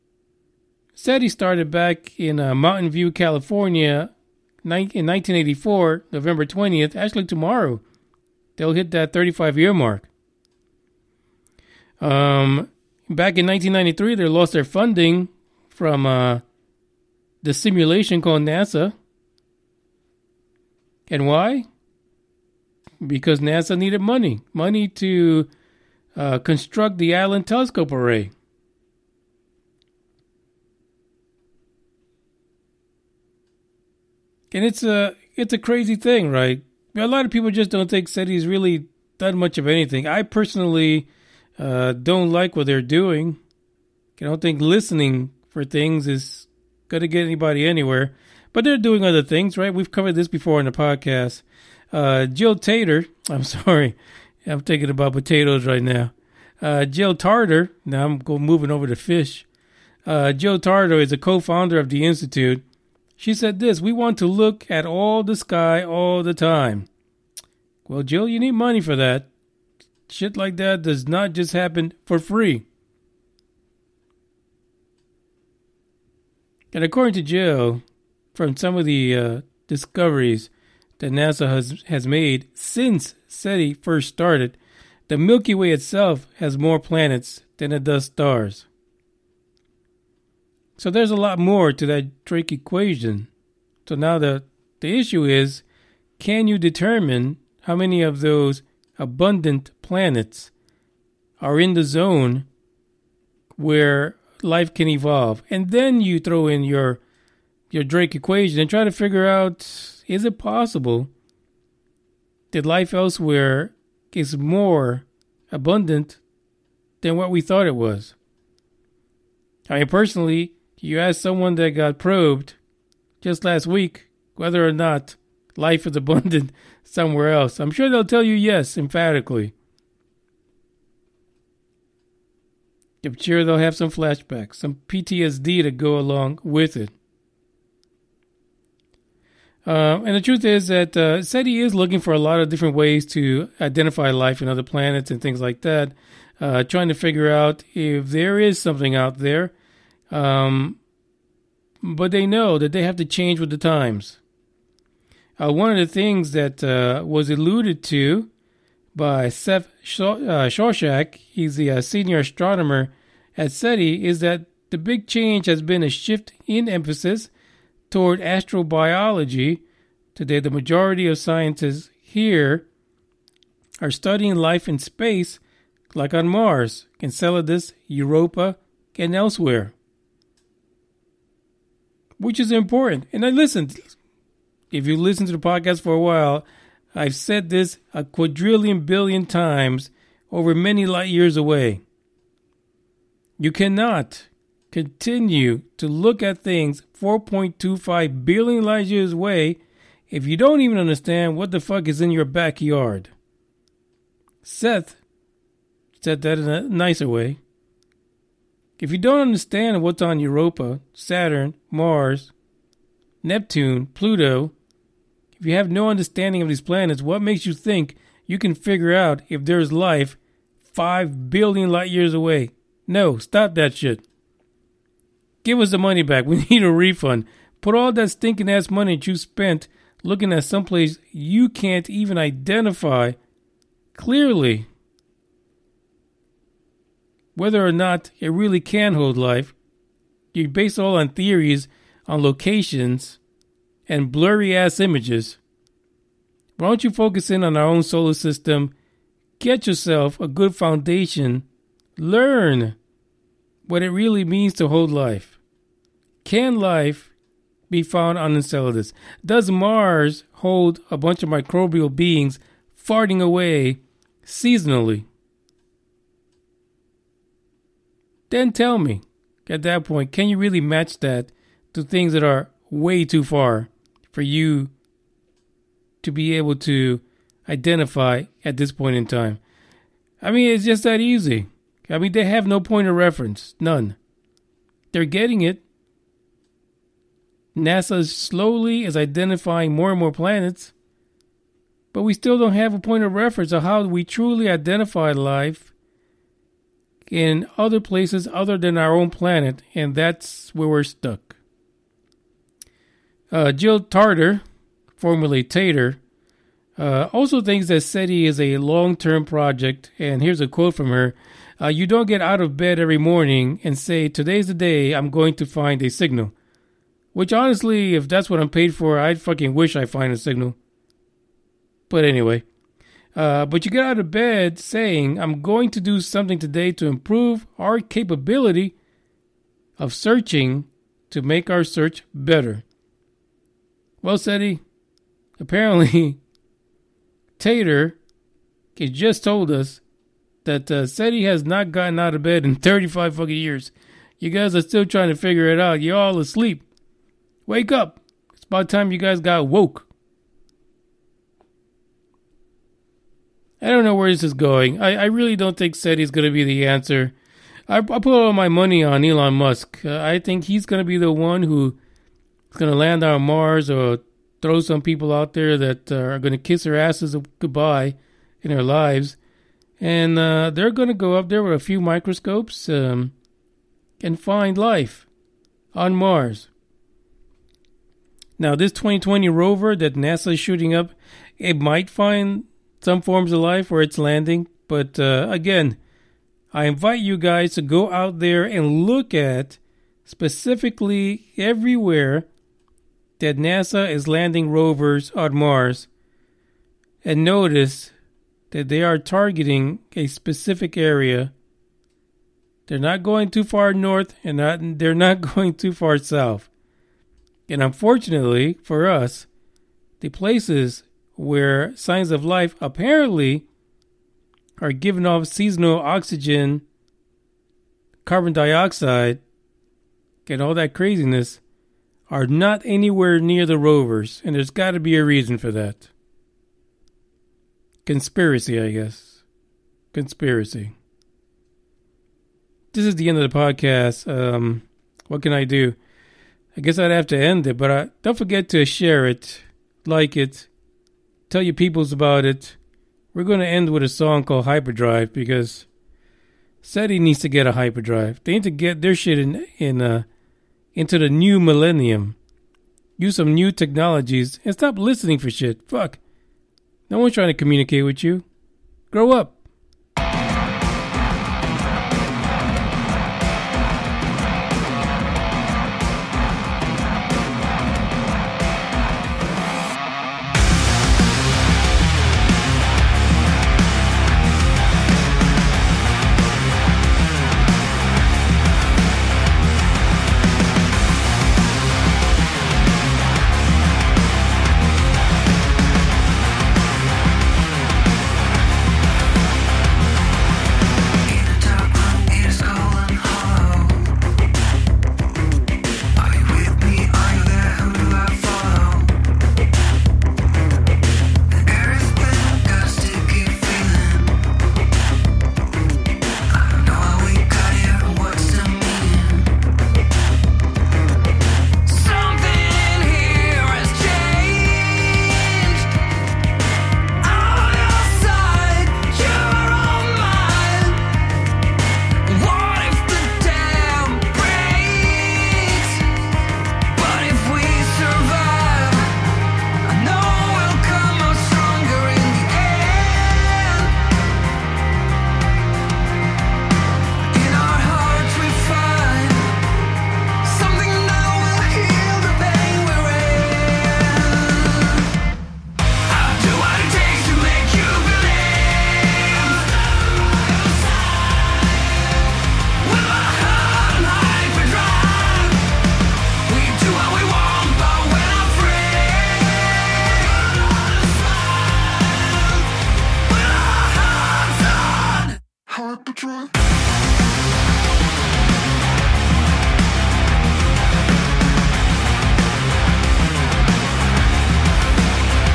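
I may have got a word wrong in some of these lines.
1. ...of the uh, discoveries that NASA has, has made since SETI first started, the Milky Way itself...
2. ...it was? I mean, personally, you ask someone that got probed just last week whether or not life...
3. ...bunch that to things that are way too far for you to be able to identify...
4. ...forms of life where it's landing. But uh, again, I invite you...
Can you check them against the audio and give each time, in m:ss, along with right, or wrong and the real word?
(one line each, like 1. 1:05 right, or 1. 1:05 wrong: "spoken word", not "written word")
1. 1:18 right
2. 1:57 right
3. 4:30 wrong: "match", not "bunch"
4. 6:23 right.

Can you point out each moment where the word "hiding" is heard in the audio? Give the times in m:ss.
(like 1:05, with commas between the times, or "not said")
not said.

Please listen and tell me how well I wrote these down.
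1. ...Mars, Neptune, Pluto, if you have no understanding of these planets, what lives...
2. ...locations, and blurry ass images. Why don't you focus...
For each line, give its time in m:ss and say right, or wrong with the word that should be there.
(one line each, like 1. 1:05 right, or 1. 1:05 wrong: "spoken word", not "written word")
1. 3:31 wrong: "makes", not "lives"
2. 4:02 right.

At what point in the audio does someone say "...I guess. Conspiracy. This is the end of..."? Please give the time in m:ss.
7:08.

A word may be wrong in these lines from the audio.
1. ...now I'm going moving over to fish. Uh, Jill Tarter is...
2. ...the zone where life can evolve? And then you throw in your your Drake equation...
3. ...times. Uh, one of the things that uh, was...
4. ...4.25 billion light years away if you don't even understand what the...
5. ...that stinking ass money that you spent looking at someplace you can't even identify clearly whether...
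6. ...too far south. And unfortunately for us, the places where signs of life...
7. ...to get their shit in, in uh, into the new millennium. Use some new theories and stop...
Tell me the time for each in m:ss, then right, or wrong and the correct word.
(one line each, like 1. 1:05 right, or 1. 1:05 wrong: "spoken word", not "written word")
1. 0:57 right
2. 1:41 right
3. 2:33 right
4. 3:17 right
5. 3:47 right
6. 6:45 right
7. 7:28 wrong: "technologies", not "theories".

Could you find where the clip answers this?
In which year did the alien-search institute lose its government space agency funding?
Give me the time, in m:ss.
0:13.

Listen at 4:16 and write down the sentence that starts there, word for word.
Can life be found on Enceladus?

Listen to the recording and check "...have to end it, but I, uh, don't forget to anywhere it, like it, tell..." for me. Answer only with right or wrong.
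wrong.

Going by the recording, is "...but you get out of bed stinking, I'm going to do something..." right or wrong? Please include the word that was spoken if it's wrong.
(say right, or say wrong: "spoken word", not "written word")
wrong: "saying", not "stinking".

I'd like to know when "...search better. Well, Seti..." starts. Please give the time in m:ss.
5:31.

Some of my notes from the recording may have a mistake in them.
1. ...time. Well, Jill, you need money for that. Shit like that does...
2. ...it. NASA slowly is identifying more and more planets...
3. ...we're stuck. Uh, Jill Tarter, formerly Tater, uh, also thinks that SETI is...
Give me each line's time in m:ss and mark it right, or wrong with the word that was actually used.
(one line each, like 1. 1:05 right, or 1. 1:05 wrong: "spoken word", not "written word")
1. 1:06 right
2. 4:45 right
3. 5:00 right.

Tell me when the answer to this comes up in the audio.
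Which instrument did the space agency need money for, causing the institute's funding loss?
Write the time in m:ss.
0:27.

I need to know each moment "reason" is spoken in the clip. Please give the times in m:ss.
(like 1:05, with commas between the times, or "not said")
7:05.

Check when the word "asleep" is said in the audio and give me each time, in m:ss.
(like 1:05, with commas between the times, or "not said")
5:46.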